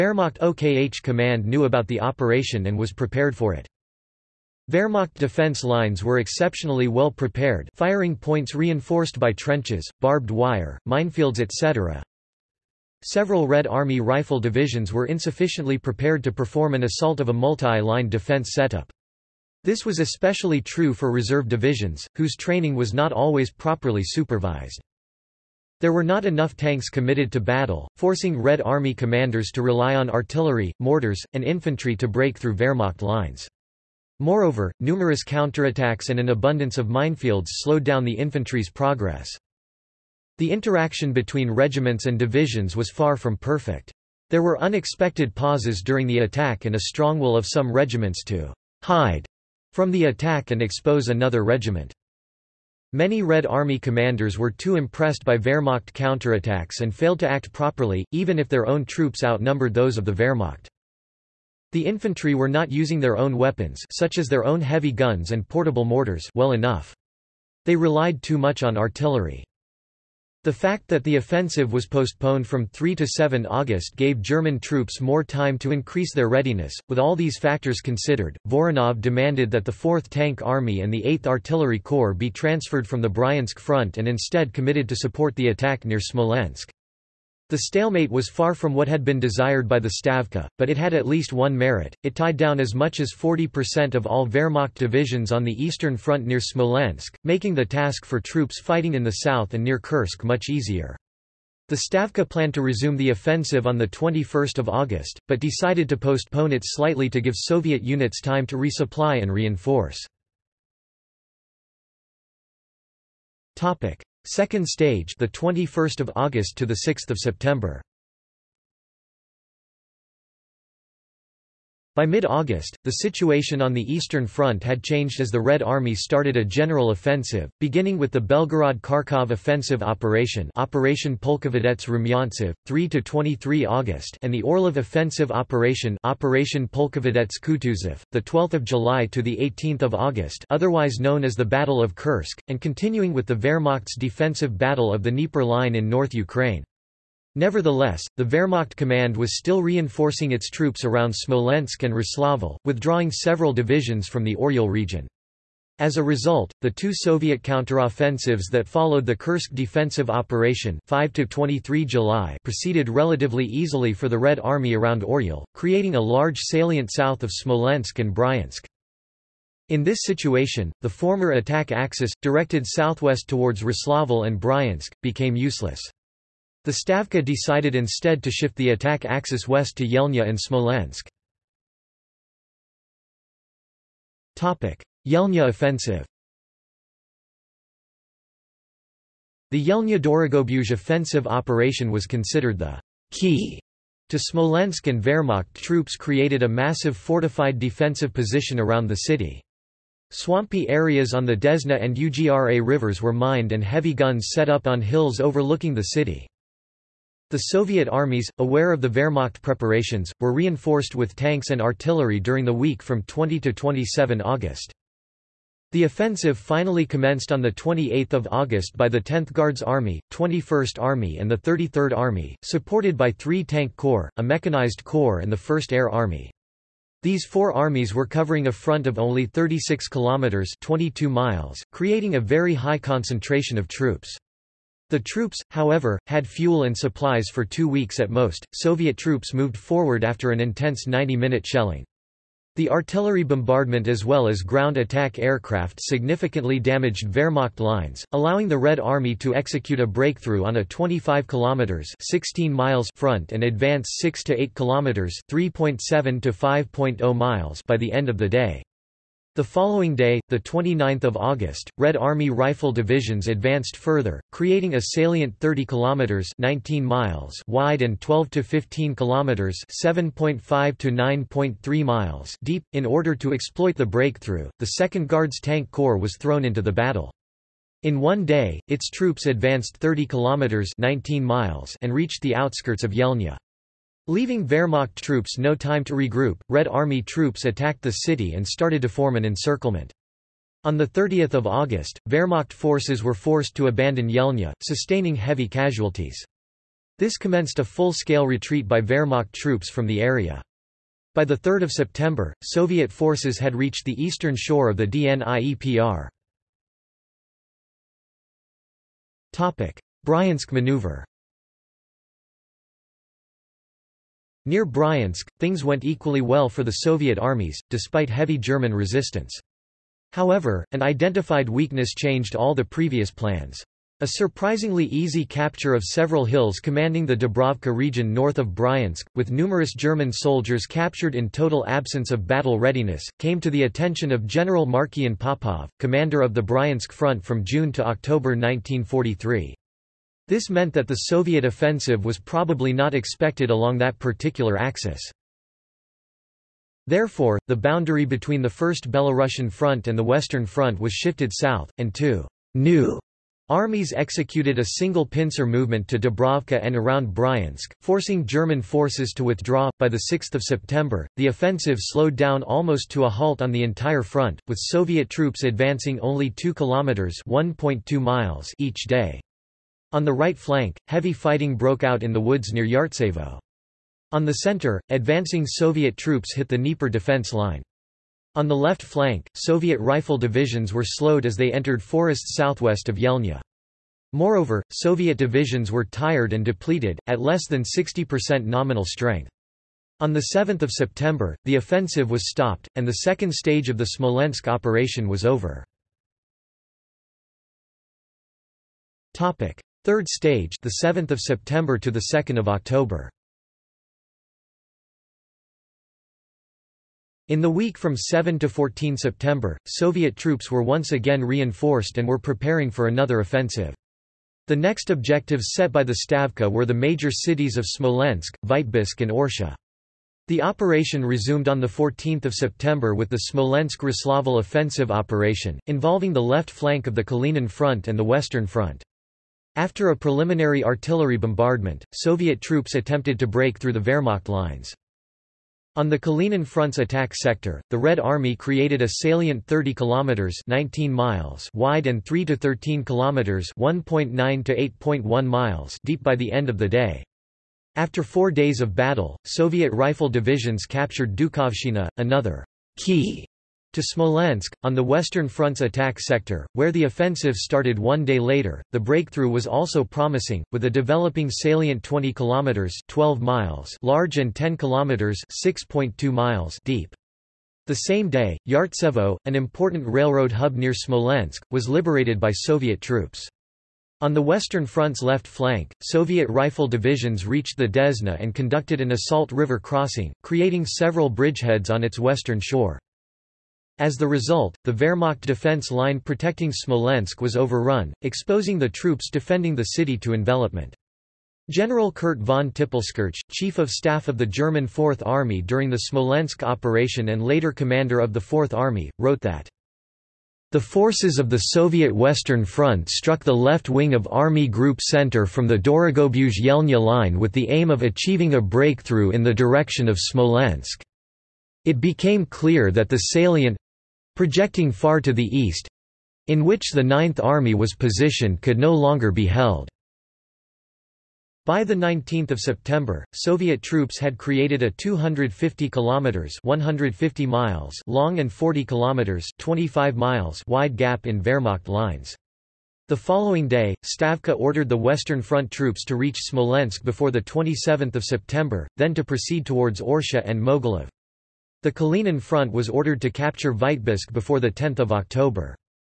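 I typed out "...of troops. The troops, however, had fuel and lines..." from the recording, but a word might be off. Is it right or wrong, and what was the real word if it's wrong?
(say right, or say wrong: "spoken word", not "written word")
wrong: "supplies", not "lines".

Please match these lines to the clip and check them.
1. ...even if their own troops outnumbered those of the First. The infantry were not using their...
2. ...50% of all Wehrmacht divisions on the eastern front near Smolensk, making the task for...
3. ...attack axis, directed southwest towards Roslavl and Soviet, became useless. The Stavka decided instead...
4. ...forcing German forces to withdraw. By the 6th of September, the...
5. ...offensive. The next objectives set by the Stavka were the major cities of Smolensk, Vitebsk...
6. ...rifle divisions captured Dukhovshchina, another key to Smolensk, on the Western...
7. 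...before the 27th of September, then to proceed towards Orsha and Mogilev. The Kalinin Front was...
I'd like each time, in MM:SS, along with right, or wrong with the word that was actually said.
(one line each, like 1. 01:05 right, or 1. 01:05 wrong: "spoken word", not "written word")
1. 00:58 wrong: "Wehrmacht", not "First"
2. 01:33 wrong: "40", not "50"
3. 02:51 wrong: "Bryansk", not "Soviet"
4. 05:57 right
5. 06:53 right
6. 07:29 right
7. 08:56 right.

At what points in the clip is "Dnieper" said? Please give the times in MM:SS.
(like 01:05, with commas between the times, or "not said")
02:25, 05:04, 06:16.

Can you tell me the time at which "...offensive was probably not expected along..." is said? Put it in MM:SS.
05:41.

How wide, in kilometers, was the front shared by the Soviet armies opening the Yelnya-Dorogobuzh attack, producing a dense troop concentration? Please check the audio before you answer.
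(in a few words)
36 kilometers.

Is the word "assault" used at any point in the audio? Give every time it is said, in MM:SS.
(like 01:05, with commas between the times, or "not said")
00:16, 07:58.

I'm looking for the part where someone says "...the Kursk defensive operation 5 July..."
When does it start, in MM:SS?
02:39.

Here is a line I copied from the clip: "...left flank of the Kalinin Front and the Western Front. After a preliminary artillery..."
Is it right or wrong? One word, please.
right.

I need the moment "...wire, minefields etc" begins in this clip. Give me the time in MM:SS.
00:10.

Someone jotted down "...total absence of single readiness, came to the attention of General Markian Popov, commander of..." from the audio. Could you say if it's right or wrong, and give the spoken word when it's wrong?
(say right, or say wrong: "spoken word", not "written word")
wrong: "battle", not "single".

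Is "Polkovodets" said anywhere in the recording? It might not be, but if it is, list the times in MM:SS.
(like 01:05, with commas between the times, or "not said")
02:11, 02:16.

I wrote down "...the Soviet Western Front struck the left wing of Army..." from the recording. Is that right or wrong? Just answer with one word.
right.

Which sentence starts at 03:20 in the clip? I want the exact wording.
Swampy areas on the Desna and Ugra rivers were mined and heavy guns set up on hills overlooking the city.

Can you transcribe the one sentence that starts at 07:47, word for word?
The same day, Yartsevo, an important railroad hub near Smolensk, was liberated by Soviet troops.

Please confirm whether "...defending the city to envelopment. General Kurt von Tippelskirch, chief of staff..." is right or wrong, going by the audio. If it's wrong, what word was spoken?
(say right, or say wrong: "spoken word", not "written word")
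right.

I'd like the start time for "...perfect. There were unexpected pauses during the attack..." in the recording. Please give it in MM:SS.
00:43.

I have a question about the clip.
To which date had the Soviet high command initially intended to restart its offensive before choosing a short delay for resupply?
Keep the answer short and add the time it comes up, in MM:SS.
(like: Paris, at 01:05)
21 August, at 01:43.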